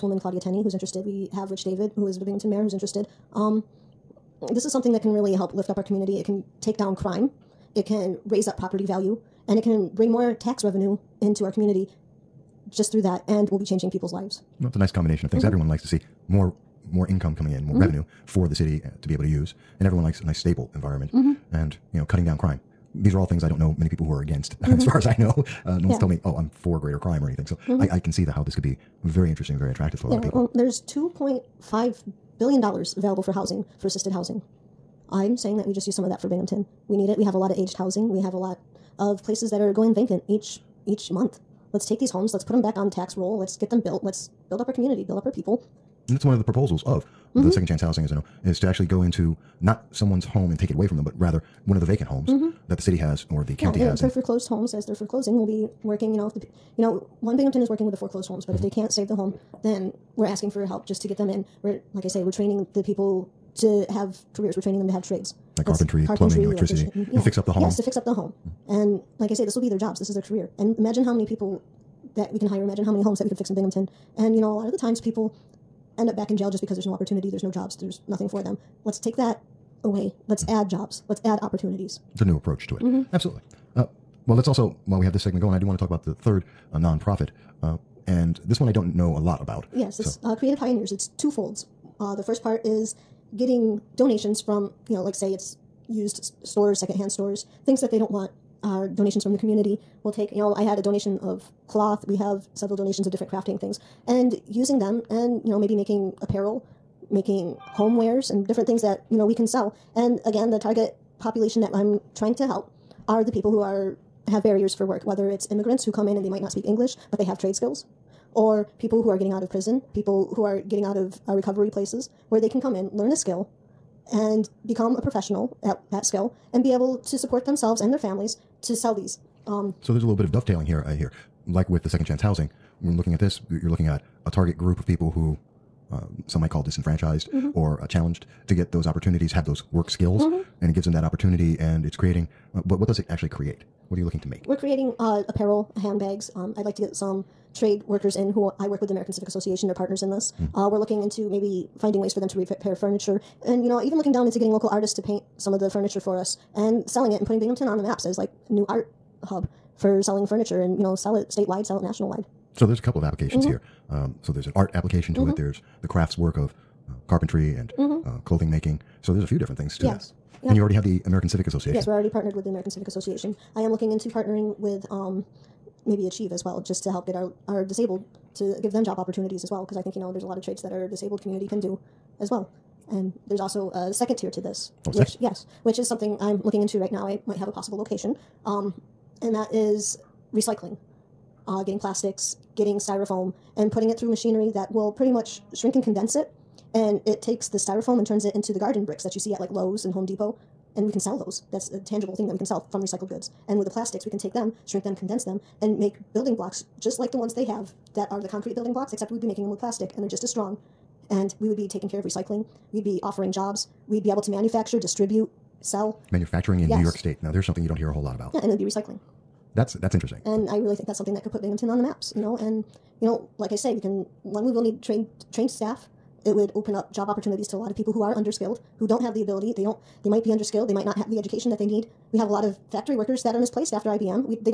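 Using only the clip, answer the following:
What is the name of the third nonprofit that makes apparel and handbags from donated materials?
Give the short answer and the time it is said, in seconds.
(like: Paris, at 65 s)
Creative Pioneers, at 90 s.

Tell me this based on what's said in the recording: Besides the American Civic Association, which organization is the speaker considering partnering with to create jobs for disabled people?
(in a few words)
Achieve.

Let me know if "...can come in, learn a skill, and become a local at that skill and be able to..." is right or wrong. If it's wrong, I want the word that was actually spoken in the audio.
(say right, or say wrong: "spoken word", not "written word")
wrong: "professional", not "local".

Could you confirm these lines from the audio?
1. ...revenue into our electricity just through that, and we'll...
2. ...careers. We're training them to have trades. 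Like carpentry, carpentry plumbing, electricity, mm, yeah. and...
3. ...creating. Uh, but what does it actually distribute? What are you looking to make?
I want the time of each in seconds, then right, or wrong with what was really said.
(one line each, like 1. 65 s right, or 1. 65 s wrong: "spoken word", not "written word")
1. 10 s wrong: "community", not "electricity"
2. 64 s right
3. 141 s wrong: "create", not "distribute".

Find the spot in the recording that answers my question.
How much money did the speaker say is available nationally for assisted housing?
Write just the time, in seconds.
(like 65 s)
30 s.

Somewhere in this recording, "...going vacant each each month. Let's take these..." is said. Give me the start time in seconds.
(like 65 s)
39 s.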